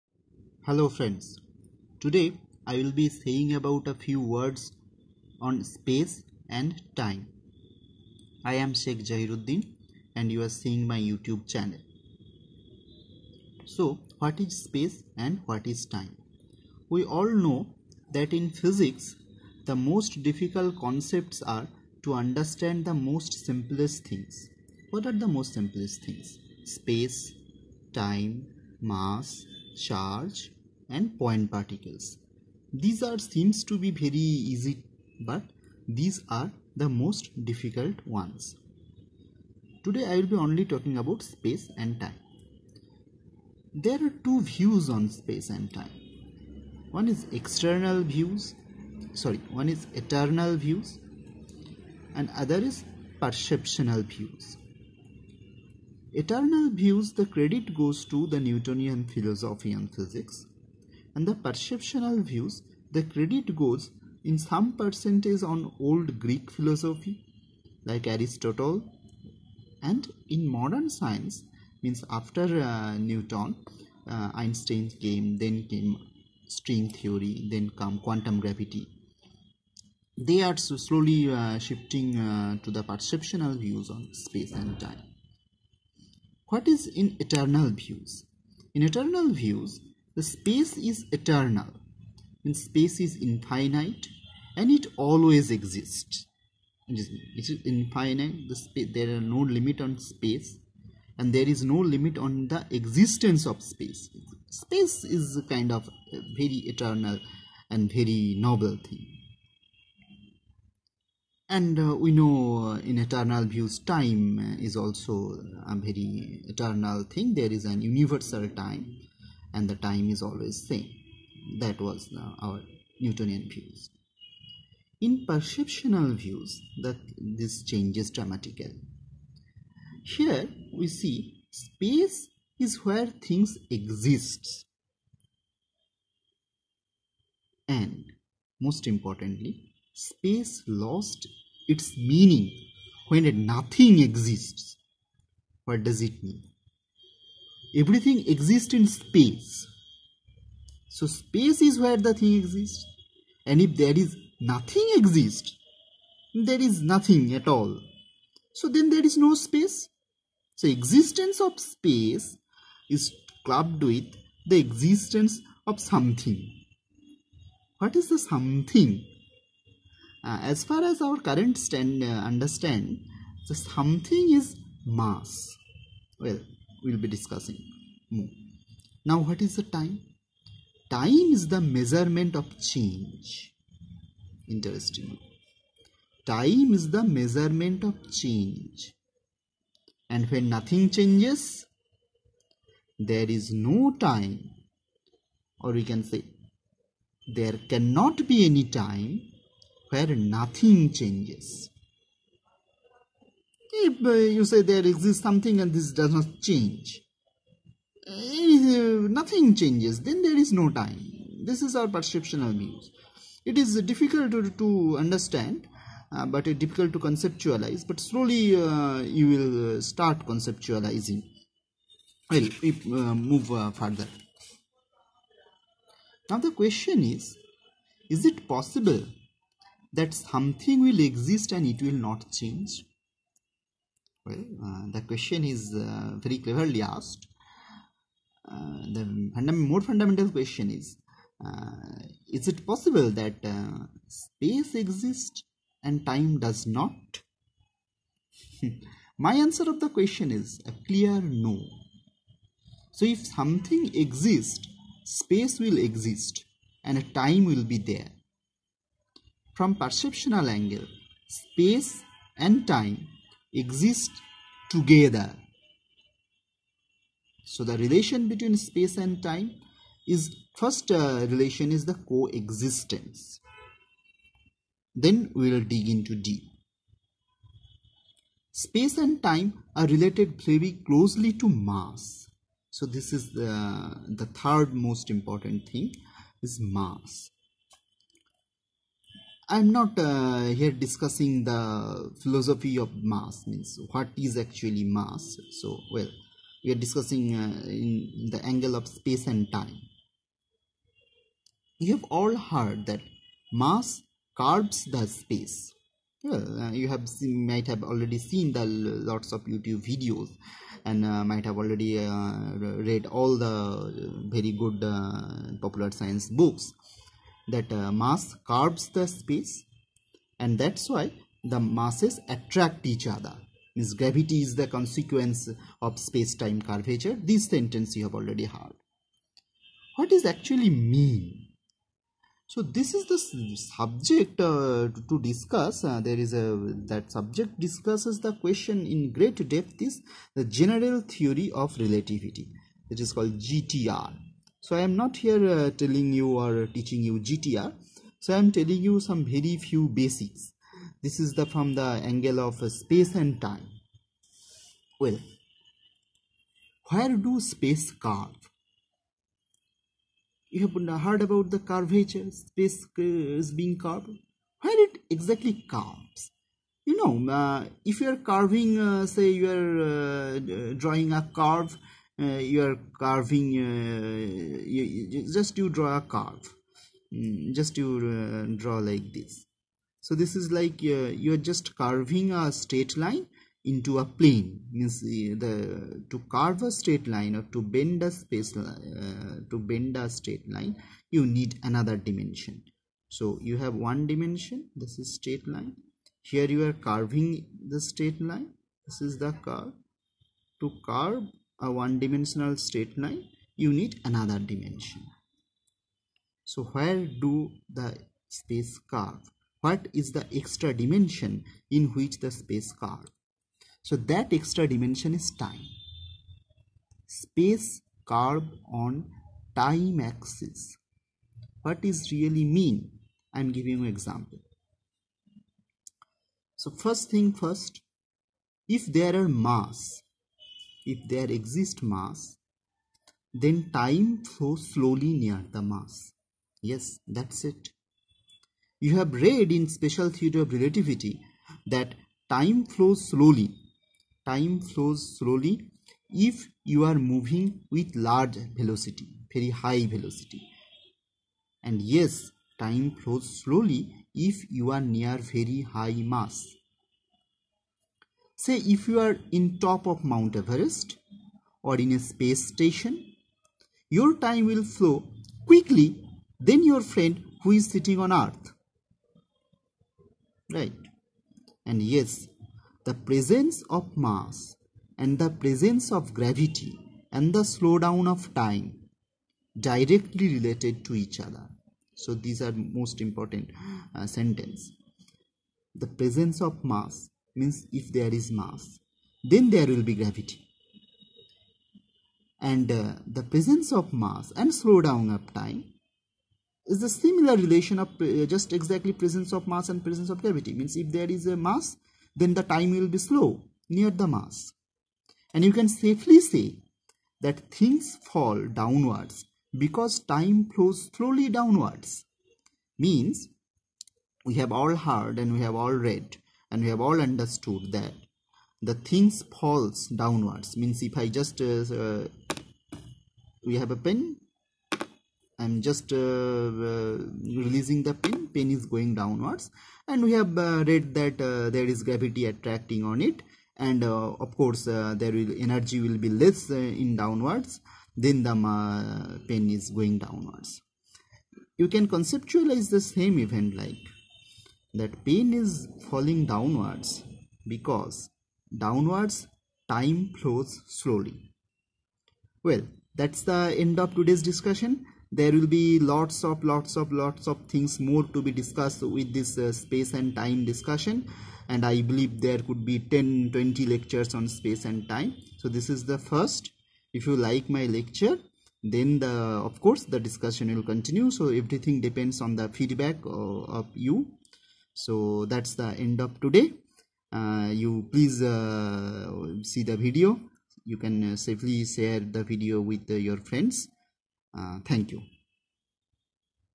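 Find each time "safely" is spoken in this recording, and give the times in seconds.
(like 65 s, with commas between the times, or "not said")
505 s, 581 s.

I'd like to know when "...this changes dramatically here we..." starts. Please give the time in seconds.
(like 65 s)
127 s.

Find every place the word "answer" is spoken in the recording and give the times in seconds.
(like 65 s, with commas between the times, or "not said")
249 s.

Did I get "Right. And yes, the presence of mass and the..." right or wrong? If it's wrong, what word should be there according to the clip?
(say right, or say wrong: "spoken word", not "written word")
right.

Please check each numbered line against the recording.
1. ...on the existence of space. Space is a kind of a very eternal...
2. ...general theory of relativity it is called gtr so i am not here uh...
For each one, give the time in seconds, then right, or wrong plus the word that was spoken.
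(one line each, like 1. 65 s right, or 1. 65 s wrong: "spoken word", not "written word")
1. 102 s right
2. 340 s right.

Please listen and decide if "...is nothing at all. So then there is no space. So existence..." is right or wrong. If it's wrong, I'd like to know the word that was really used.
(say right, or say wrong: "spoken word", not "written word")
right.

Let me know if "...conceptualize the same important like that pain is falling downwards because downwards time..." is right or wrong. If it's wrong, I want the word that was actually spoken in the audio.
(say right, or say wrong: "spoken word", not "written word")
wrong: "event", not "important".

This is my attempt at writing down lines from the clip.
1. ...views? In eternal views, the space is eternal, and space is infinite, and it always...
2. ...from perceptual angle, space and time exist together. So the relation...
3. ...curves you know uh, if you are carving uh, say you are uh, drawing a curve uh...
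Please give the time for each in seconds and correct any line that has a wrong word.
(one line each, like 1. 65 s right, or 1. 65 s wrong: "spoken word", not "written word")
1. 87 s right
2. 259 s right
3. 365 s right.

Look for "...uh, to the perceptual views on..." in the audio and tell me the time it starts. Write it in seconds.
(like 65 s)
82 s.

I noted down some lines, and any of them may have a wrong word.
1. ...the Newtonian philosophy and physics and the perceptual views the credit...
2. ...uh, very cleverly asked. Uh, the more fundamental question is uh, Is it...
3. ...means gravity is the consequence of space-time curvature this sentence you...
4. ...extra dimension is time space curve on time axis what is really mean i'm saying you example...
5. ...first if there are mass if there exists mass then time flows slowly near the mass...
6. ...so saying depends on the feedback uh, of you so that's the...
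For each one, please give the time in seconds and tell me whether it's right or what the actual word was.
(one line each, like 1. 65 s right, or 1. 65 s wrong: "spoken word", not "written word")
1. 58 s right
2. 235 s right
3. 323 s right
4. 414 s wrong: "giving", not "saying"
5. 427 s right
6. 571 s wrong: "everything", not "saying".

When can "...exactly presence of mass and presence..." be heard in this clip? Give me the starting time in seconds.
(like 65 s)
498 s.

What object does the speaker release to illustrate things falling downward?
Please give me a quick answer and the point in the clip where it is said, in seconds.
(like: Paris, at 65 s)
pen, at 523 s.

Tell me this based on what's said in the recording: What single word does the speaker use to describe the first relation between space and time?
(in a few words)
coexistence.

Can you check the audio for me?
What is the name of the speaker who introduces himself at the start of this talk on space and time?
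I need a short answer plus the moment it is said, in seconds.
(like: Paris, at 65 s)
Sheikh Jahiruddin, at 8 s.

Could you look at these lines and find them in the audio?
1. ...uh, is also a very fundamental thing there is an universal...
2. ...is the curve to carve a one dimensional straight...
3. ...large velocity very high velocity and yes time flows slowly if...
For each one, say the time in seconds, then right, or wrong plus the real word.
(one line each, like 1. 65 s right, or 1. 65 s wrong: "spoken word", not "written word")
1. 114 s wrong: "eternal", not "fundamental"
2. 399 s right
3. 447 s right.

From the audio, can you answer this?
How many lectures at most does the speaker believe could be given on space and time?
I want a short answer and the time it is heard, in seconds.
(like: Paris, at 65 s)
20, at 563 s.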